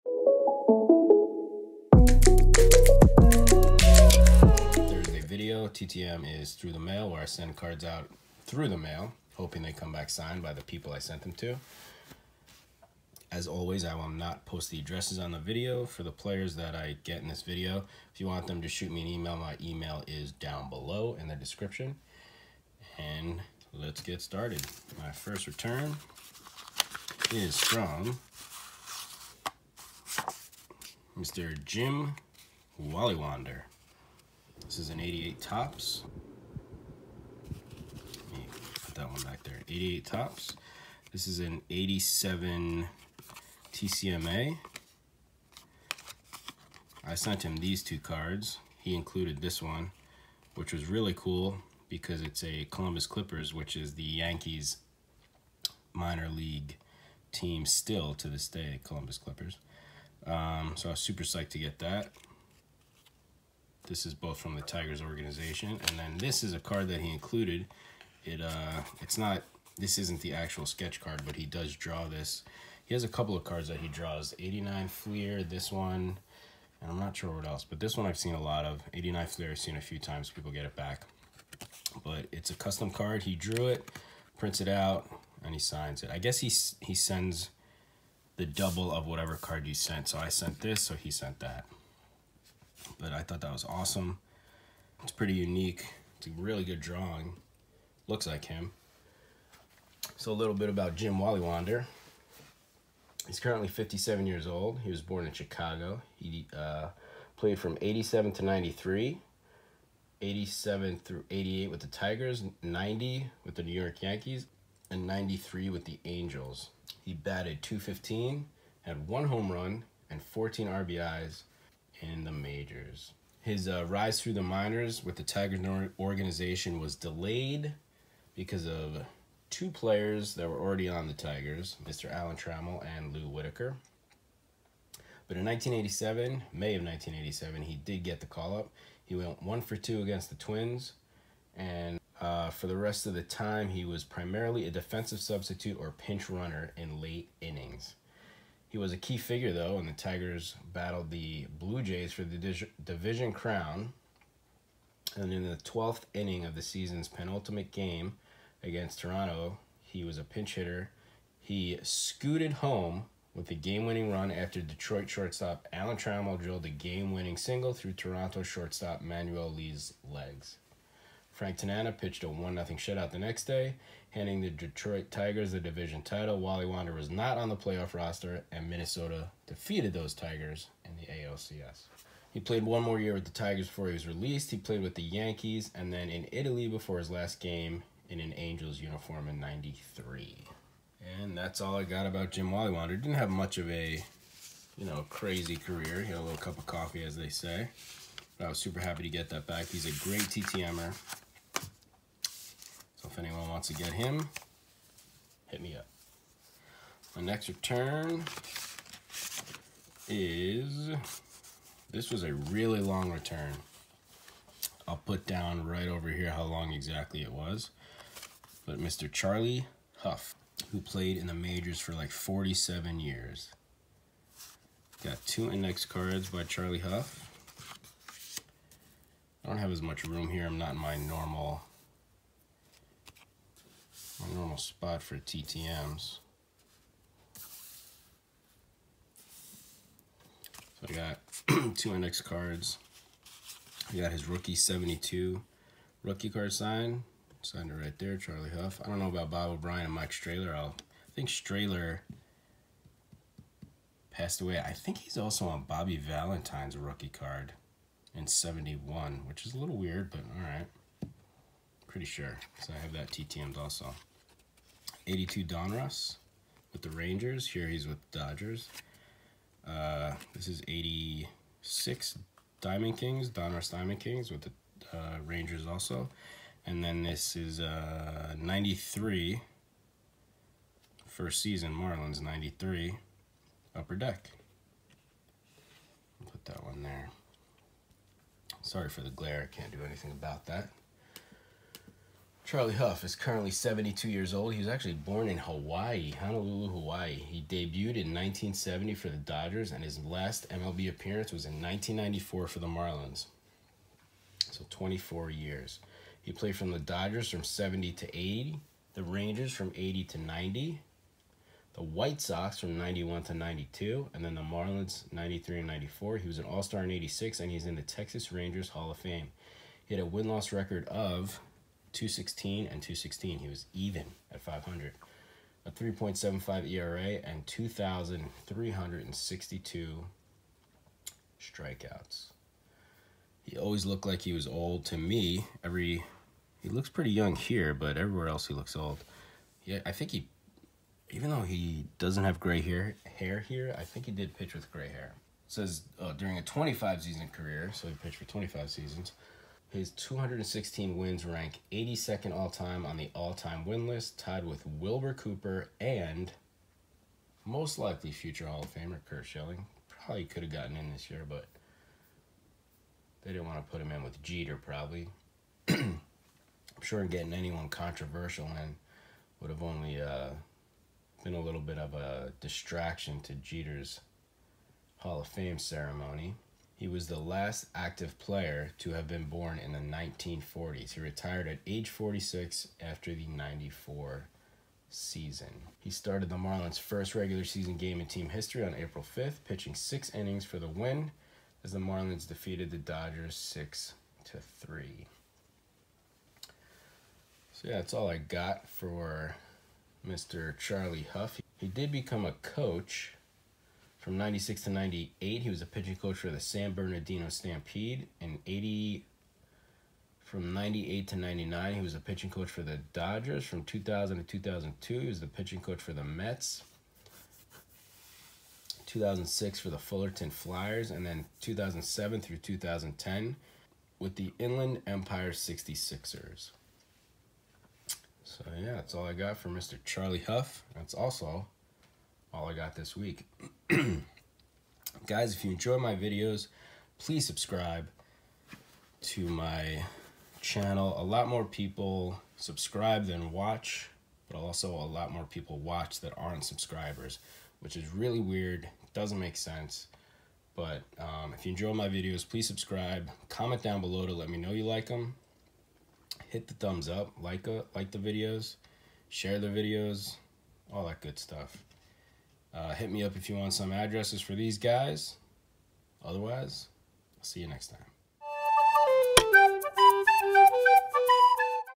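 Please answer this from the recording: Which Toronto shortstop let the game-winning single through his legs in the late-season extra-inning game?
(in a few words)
Manuel Lee.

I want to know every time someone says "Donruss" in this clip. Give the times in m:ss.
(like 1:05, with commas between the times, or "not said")
4:25, 4:33.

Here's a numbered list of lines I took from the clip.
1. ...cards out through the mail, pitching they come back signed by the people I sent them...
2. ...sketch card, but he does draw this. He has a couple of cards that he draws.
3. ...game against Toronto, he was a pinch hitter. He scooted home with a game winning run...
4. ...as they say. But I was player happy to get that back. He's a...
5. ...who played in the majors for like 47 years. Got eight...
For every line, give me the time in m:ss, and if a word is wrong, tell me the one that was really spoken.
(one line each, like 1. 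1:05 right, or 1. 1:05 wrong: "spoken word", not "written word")
1. 0:07 wrong: "hoping", not "pitching"
2. 1:10 right
3. 2:37 right
4. 3:17 wrong: "super", not "player"
5. 3:40 wrong: "two", not "eight".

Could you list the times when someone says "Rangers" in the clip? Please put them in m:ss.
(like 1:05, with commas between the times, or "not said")
4:26, 4:35, 5:09, 5:18.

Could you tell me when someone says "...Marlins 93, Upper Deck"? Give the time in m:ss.
4:41.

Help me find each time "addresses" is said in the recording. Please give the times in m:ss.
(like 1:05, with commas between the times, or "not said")
0:14, 7:43.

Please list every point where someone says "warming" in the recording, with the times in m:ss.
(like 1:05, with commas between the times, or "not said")
not said.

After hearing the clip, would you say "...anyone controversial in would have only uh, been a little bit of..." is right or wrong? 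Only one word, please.
right.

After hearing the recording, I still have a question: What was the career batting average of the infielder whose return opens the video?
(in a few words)
215.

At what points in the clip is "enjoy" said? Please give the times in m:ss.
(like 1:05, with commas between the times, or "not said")
7:15, 7:31.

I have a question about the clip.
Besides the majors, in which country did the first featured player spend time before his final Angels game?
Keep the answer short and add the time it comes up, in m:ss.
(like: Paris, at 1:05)
Italy, at 3:06.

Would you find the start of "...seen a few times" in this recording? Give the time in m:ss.
1:19.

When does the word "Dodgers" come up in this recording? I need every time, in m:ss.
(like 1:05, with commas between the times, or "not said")
4:28, 4:59, 5:06, 6:32, 6:52.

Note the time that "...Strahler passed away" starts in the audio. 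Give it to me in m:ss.
4:11.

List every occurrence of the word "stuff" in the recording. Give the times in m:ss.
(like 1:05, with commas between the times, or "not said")
7:41.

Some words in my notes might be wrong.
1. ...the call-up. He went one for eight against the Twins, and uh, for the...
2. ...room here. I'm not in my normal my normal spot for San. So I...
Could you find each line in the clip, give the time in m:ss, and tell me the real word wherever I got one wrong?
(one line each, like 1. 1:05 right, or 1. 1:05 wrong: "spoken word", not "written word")
1. 2:18 wrong: "two", not "eight"
2. 3:50 wrong: "TTMs", not "San".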